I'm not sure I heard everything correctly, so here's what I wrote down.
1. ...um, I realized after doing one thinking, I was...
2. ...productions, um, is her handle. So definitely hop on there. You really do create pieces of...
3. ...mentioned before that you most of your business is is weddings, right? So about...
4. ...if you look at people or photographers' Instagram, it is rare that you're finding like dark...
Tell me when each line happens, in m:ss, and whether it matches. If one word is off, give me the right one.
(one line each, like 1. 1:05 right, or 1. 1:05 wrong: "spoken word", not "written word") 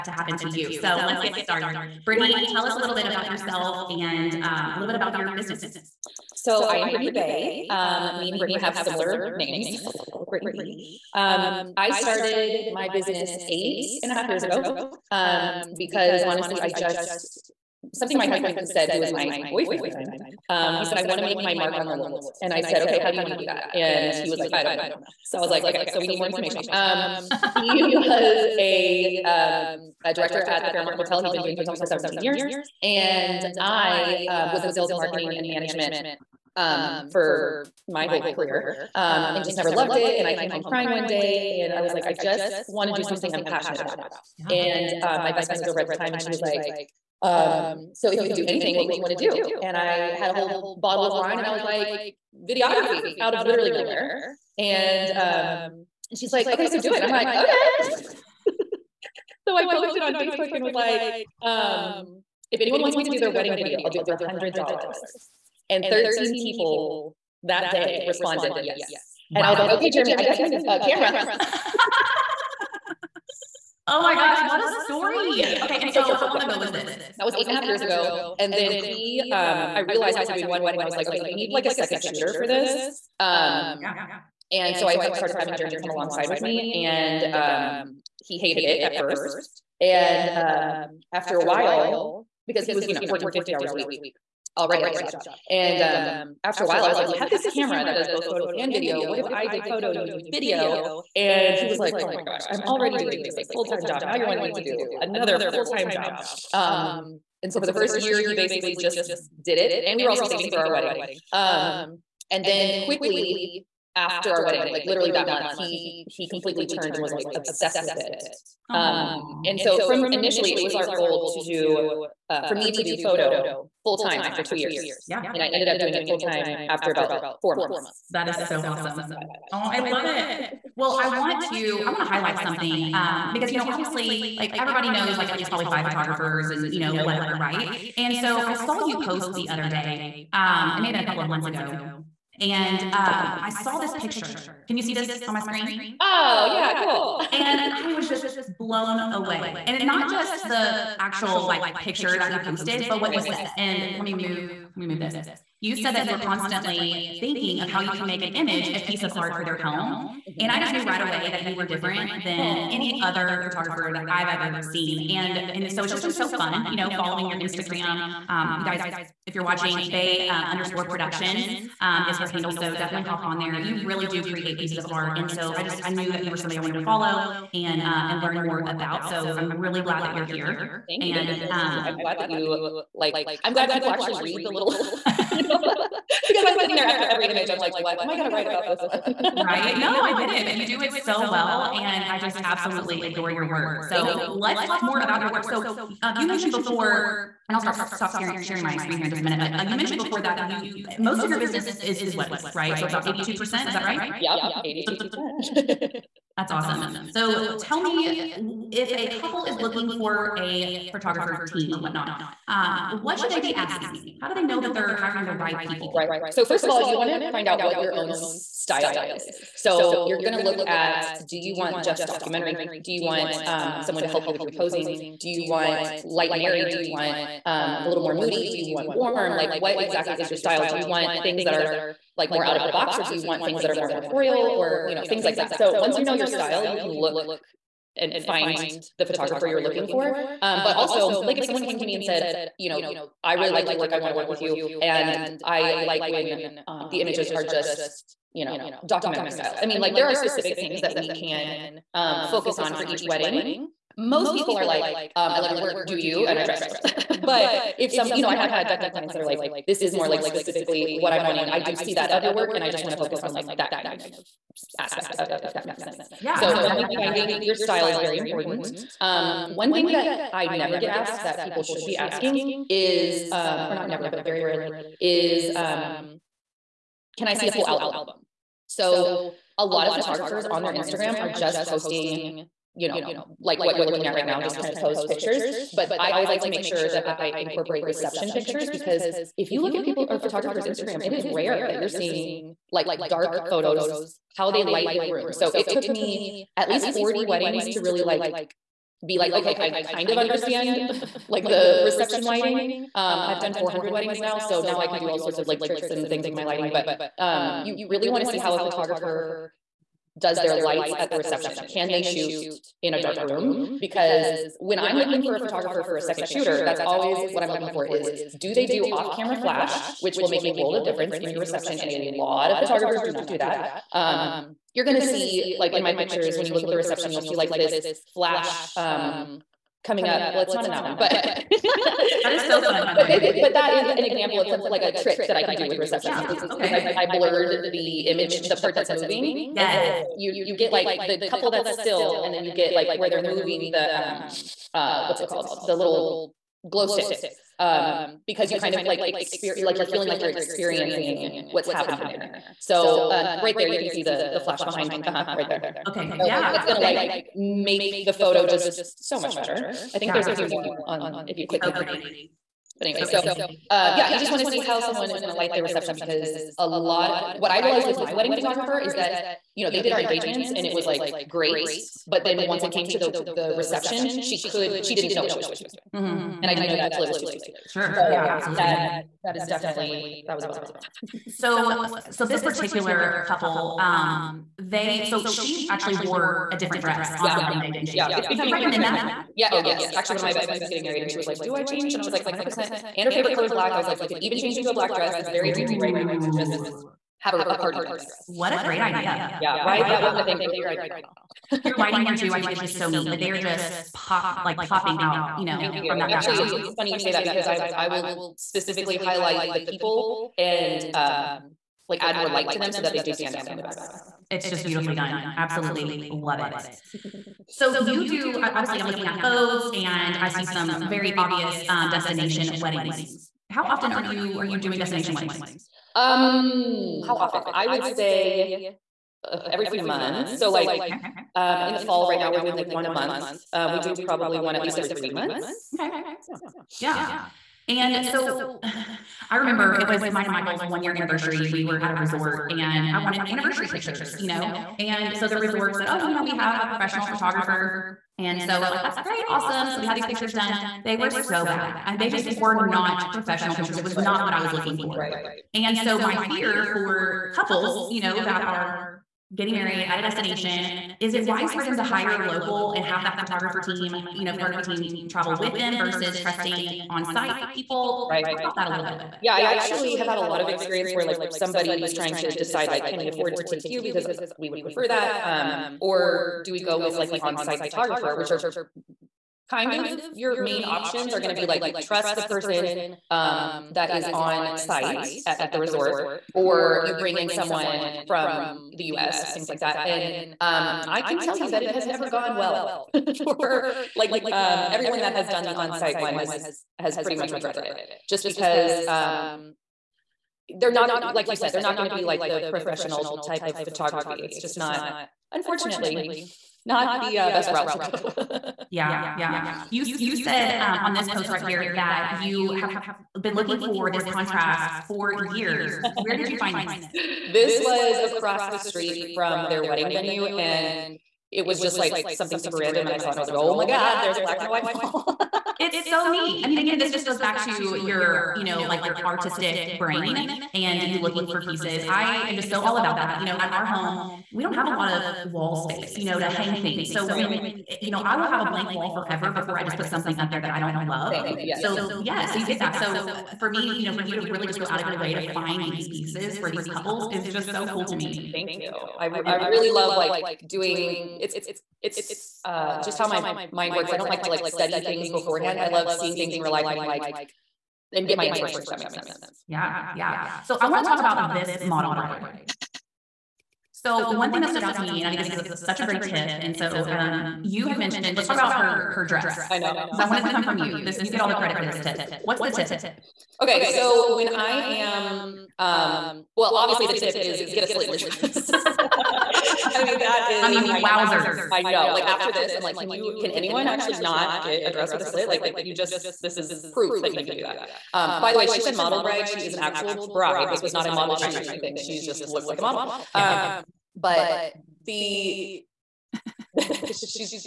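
1. 1:19 wrong: "wedding", not "thinking"
2. 2:50 right
3. 3:19 right
4. 4:49 wrong: "seeing", not "finding".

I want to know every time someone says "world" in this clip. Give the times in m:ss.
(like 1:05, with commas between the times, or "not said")
0:21, 5:20.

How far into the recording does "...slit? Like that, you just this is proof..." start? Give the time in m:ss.
9:45.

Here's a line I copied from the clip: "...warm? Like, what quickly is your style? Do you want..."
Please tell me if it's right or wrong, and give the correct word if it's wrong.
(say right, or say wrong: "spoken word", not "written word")
wrong: "exactly", not "quickly".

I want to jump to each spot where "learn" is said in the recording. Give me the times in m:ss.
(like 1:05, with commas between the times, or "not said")
2:58.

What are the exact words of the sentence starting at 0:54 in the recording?
And um, and she's like, okay, so do it.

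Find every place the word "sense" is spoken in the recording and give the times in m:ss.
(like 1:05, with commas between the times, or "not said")
4:25, 9:18.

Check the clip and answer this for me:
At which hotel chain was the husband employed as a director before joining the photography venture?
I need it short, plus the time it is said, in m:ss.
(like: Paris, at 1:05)
Fairmont Hotel, at 0:30.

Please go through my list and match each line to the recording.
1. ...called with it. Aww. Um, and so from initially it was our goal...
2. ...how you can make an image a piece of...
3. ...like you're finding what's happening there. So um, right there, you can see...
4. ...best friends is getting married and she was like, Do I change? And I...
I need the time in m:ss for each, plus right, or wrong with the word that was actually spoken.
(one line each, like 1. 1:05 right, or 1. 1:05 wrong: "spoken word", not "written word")
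1. 1:57 wrong: "obsessed", not "called"
2. 2:37 right
3. 5:50 wrong: "experiencing", not "finding"
4. 6:30 right.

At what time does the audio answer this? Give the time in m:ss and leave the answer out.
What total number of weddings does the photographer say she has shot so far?
5:03.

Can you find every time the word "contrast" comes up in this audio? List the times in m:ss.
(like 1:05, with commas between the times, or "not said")
8:34.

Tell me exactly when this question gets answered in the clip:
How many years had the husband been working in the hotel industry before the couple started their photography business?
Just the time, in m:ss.
0:31.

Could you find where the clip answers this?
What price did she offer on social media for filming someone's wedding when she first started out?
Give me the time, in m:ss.
1:04.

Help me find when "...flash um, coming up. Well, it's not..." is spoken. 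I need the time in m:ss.
5:28.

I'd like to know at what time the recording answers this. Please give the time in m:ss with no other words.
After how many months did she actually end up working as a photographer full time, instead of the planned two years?
2:06.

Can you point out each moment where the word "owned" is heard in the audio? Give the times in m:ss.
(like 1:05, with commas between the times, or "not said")
not said.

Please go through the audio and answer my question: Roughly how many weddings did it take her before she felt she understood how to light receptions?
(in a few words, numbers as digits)
40.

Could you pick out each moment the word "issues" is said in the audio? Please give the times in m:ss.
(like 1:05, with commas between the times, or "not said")
not said.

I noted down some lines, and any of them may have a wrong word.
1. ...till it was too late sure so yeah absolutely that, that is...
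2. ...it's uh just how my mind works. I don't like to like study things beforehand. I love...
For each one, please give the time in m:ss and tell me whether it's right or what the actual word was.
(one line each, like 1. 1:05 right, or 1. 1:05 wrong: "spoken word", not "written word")
1. 6:16 right
2. 9:11 right.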